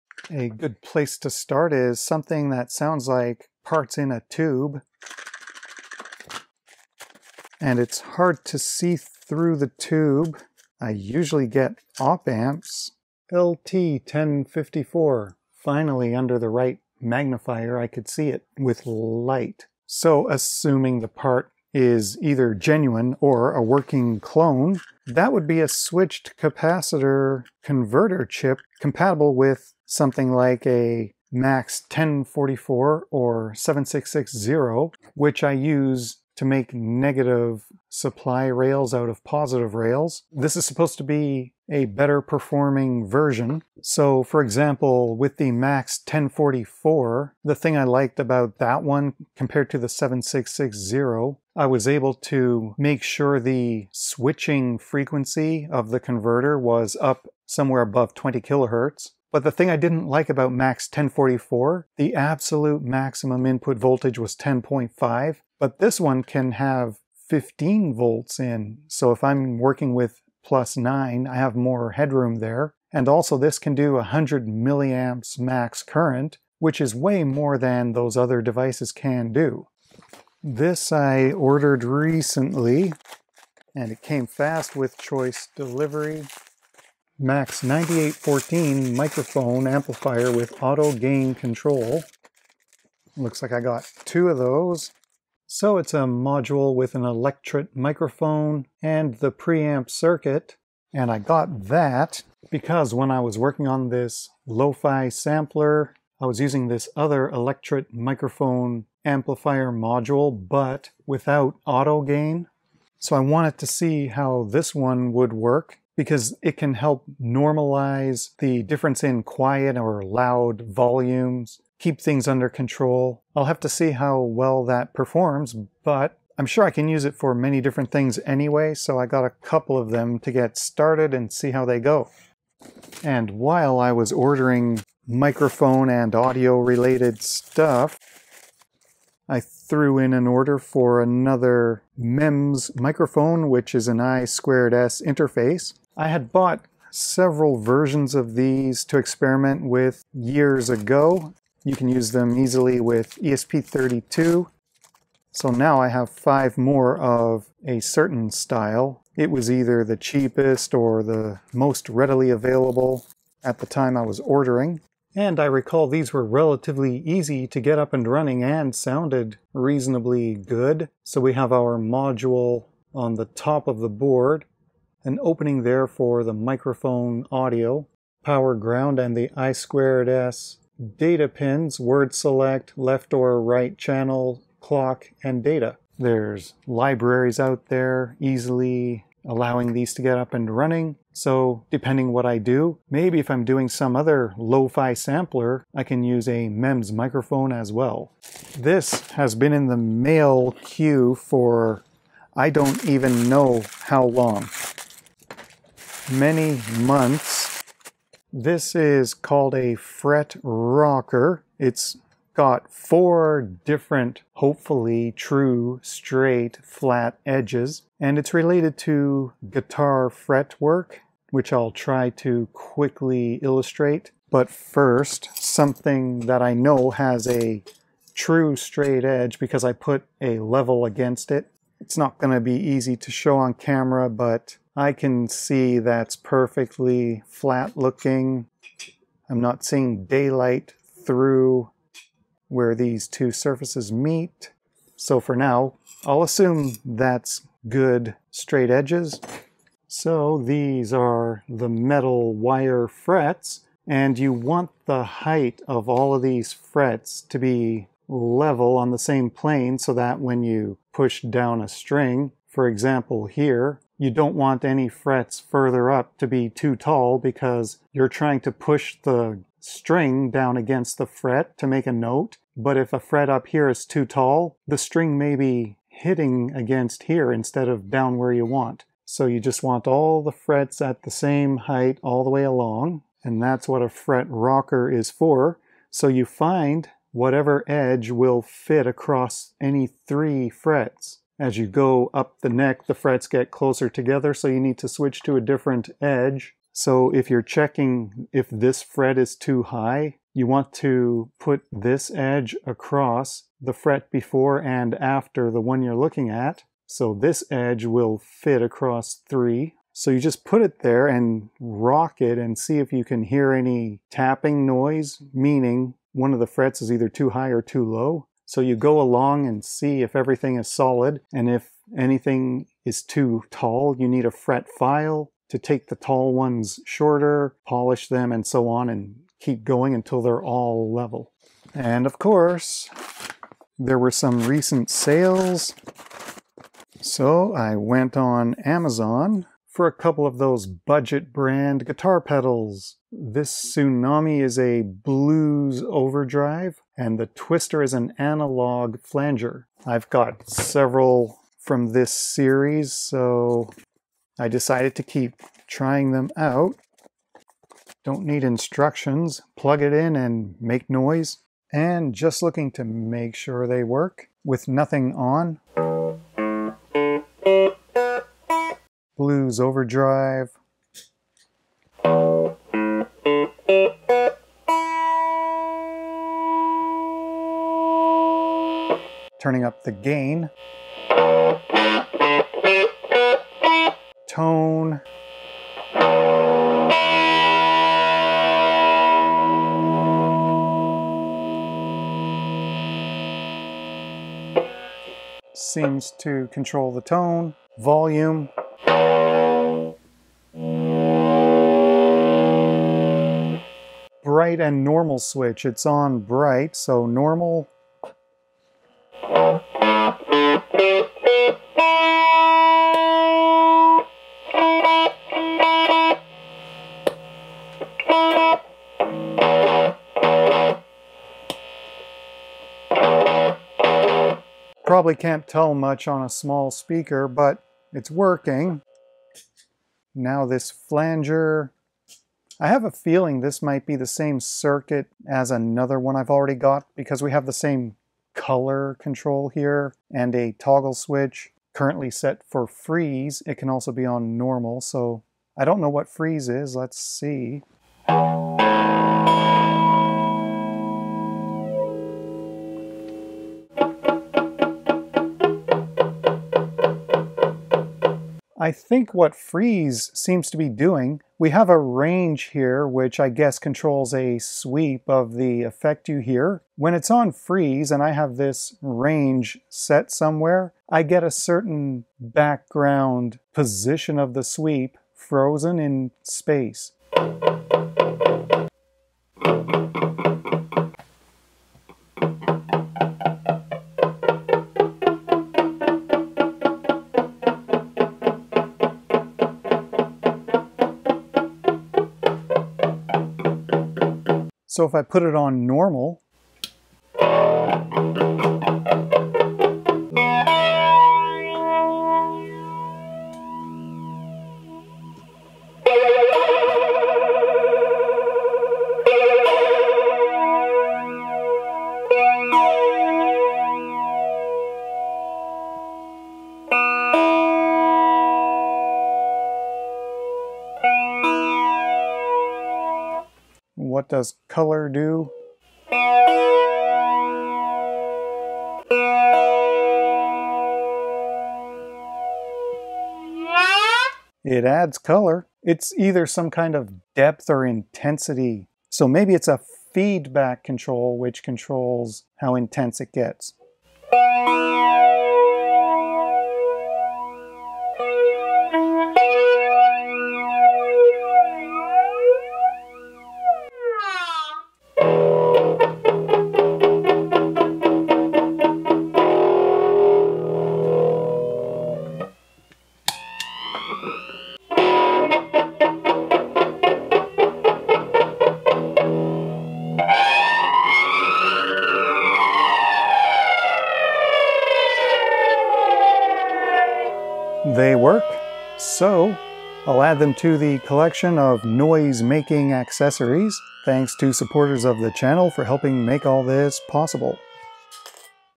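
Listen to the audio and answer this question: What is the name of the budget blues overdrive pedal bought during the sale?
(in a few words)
Tsunami.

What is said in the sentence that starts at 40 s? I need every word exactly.
This is supposed to be a better performing version.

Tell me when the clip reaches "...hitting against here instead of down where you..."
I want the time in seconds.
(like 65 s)
275 s.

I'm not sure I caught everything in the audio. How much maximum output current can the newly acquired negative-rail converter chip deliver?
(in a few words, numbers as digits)
100 milliamps.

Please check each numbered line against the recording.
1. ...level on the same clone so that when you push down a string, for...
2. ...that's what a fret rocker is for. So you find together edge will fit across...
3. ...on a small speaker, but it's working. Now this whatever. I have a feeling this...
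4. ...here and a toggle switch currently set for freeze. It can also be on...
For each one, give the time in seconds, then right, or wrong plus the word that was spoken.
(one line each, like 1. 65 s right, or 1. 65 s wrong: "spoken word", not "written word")
1. 258 s wrong: "plane", not "clone"
2. 283 s wrong: "whatever", not "together"
3. 426 s wrong: "flanger", not "whatever"
4. 439 s right.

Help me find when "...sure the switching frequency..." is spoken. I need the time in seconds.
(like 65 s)
53 s.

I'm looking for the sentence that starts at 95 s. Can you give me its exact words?
So it's a module with an electret microphone and the preamp circuit.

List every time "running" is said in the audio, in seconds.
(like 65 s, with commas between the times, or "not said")
168 s, 190 s.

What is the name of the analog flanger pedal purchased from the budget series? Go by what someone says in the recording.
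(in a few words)
Twister.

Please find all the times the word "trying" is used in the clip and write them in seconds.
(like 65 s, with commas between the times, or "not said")
268 s, 355 s.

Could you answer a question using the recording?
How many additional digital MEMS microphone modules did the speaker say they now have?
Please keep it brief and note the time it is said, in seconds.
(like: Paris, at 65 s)
5, at 156 s.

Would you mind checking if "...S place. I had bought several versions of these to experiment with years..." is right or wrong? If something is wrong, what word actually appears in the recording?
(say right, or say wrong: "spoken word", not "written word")
wrong: "interface", not "place".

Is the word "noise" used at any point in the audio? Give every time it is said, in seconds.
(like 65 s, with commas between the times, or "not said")
314 s, 360 s, 581 s.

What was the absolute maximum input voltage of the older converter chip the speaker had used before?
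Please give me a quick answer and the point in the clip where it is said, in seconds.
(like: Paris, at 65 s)
10.5, at 64 s.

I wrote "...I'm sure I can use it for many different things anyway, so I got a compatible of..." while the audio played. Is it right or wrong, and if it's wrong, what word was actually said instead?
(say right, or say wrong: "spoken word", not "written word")
wrong: "couple", not "compatible".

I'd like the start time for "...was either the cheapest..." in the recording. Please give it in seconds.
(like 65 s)
159 s.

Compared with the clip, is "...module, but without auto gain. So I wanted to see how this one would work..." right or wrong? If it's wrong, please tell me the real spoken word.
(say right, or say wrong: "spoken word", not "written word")
right.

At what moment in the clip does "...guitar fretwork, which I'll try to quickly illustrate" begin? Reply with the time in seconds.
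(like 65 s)
219 s.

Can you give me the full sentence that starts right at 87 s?
Max 9814 microphone amplifier with auto gain control.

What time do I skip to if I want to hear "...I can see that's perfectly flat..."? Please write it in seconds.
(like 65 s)
234 s.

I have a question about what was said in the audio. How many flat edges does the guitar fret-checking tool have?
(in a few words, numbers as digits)
4.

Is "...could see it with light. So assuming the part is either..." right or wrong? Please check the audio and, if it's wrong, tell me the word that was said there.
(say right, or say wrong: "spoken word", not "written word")
right.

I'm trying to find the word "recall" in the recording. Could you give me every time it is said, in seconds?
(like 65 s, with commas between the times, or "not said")
165 s.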